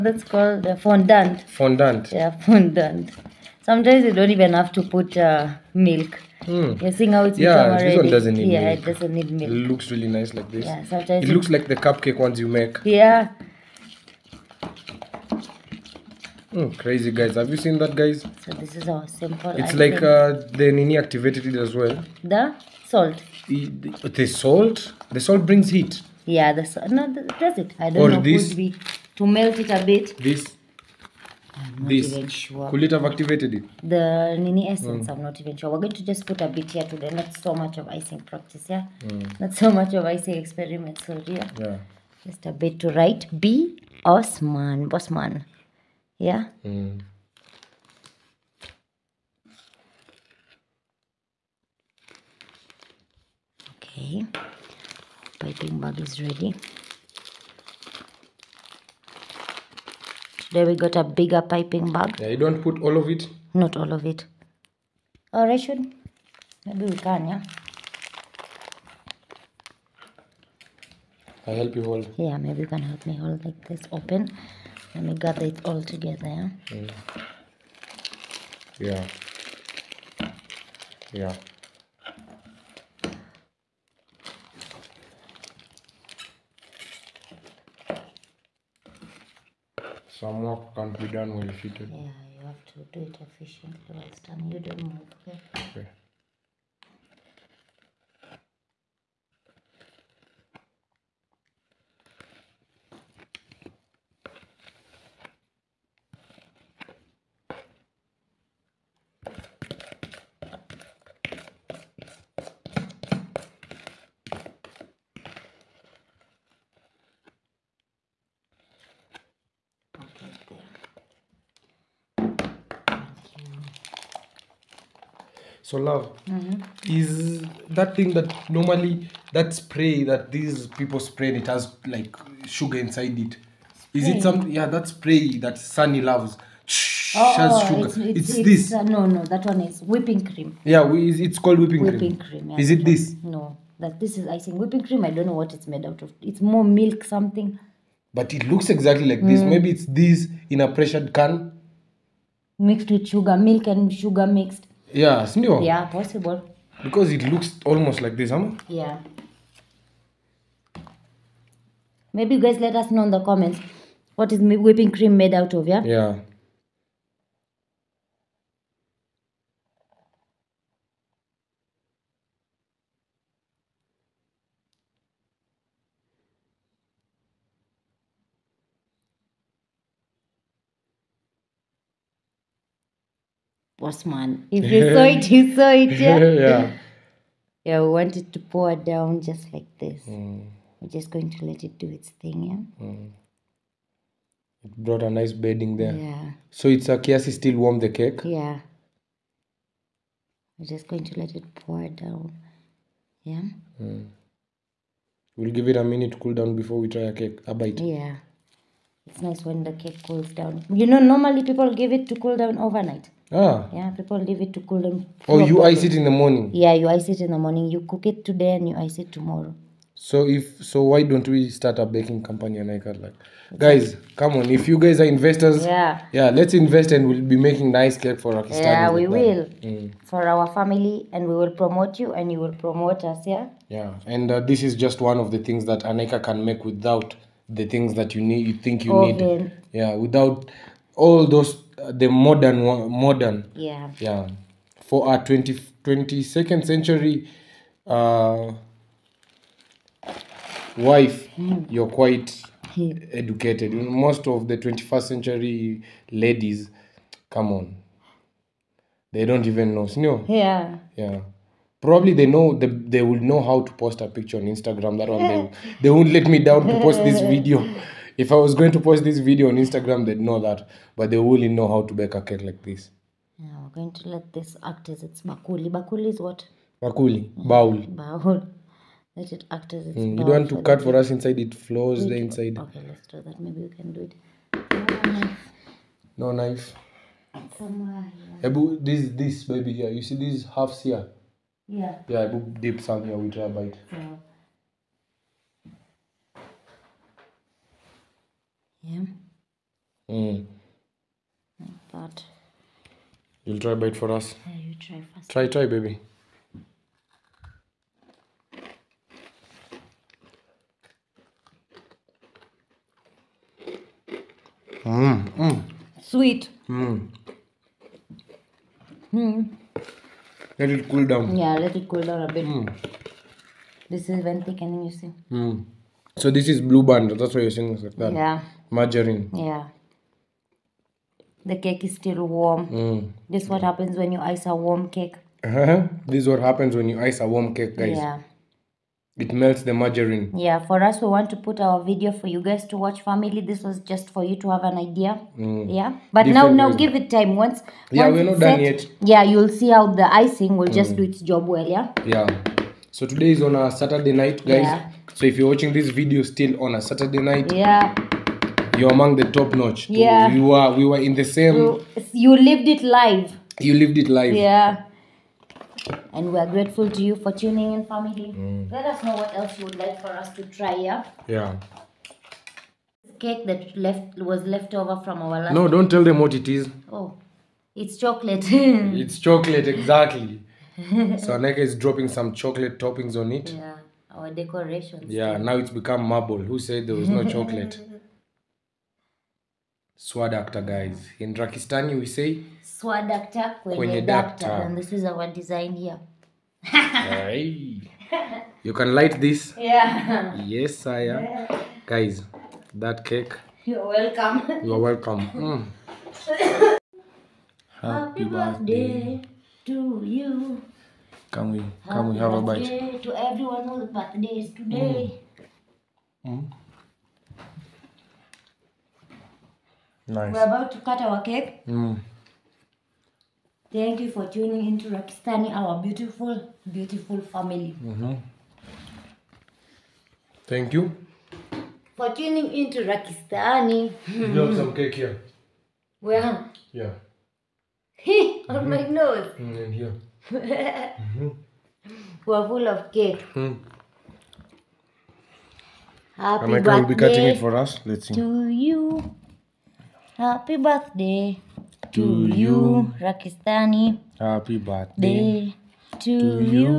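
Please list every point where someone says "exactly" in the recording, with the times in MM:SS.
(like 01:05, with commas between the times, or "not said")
02:28, 06:19.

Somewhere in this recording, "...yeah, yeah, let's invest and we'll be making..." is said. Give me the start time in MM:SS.
03:45.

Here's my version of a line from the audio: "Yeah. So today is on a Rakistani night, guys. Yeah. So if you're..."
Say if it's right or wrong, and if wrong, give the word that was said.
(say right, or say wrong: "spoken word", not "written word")
wrong: "Saturday", not "Rakistani".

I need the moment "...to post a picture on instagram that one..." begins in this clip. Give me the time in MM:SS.
04:23.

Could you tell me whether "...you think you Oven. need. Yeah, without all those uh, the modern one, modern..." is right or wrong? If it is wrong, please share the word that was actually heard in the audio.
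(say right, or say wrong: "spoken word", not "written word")
right.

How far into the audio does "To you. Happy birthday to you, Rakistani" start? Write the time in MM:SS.
07:28.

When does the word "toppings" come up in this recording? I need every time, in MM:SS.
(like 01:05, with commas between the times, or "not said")
06:22.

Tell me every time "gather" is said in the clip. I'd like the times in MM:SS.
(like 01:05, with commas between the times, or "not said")
01:15.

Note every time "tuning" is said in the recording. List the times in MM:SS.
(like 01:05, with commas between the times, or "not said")
06:07, 07:04, 07:12.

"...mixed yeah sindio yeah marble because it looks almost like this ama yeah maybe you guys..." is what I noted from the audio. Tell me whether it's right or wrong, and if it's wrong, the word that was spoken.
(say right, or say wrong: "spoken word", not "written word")
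wrong: "possible", not "marble".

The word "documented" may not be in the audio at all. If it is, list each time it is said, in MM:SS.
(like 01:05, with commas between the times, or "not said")
not said.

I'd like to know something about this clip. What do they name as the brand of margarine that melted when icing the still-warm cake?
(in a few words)
Blue Band.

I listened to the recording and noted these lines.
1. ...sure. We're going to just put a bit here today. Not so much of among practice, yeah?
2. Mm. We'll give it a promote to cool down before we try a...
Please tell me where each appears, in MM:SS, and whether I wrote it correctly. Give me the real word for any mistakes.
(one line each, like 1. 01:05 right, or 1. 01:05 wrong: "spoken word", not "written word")
1. 00:35 wrong: "icing", not "among"
2. 03:23 wrong: "minute", not "promote".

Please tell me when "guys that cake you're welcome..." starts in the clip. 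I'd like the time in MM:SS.
06:41.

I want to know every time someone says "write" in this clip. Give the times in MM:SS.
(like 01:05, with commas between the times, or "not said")
00:42.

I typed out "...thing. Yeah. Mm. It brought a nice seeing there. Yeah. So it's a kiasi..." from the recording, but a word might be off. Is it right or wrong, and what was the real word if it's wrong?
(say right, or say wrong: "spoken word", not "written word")
wrong: "bedding", not "seeing".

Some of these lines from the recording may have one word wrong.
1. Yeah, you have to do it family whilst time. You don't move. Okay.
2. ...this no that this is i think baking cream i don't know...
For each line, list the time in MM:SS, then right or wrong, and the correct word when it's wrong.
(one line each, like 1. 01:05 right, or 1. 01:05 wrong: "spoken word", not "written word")
1. 01:31 wrong: "efficiently", not "family"
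2. 02:22 wrong: "whipping", not "baking".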